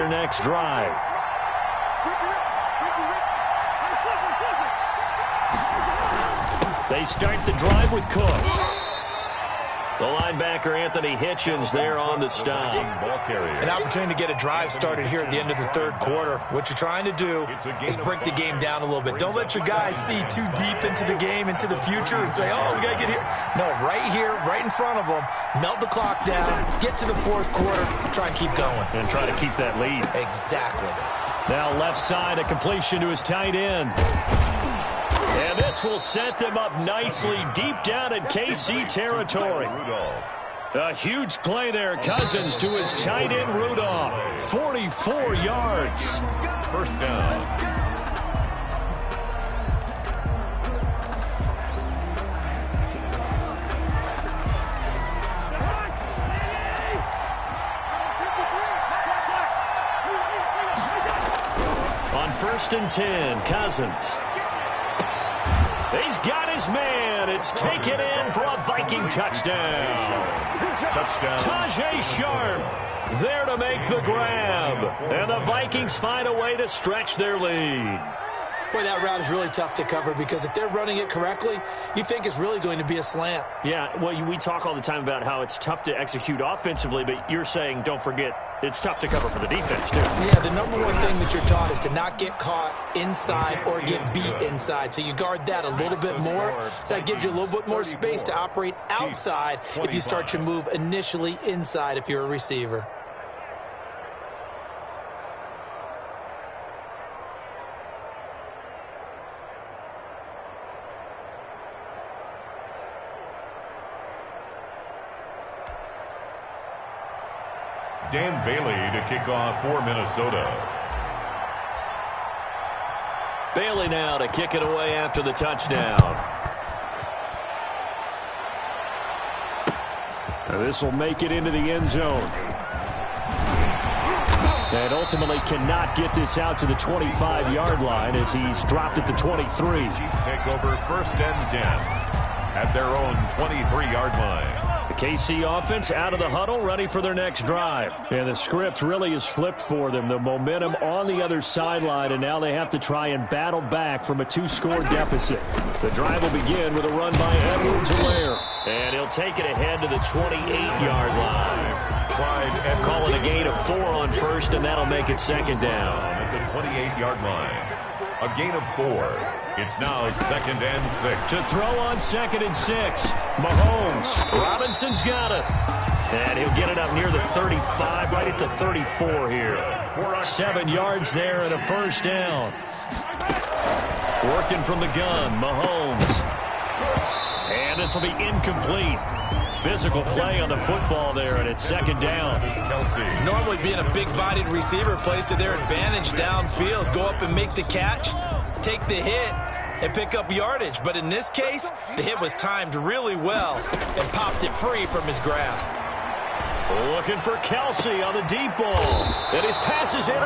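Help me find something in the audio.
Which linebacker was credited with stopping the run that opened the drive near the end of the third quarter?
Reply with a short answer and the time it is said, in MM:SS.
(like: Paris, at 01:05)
Anthony Hitchens, at 00:10.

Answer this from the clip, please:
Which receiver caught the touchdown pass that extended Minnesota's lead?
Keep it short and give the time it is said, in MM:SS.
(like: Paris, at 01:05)
Tajae Sharpe, at 01:11.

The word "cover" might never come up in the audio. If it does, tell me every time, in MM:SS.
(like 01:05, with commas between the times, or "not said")
01:19, 01:29.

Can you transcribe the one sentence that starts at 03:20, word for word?
But in this case, the hit was timed really well and popped it free from his grasp.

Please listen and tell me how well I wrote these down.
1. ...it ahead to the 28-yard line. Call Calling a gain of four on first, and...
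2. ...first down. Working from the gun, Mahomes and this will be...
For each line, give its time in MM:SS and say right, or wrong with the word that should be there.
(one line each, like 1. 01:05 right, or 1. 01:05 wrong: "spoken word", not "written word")
1. 02:39 right
2. 03:01 right.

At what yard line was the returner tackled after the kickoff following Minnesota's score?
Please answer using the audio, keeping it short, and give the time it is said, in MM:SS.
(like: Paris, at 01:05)
23, at 02:19.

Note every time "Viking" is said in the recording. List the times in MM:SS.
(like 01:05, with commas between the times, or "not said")
01:08, 01:15.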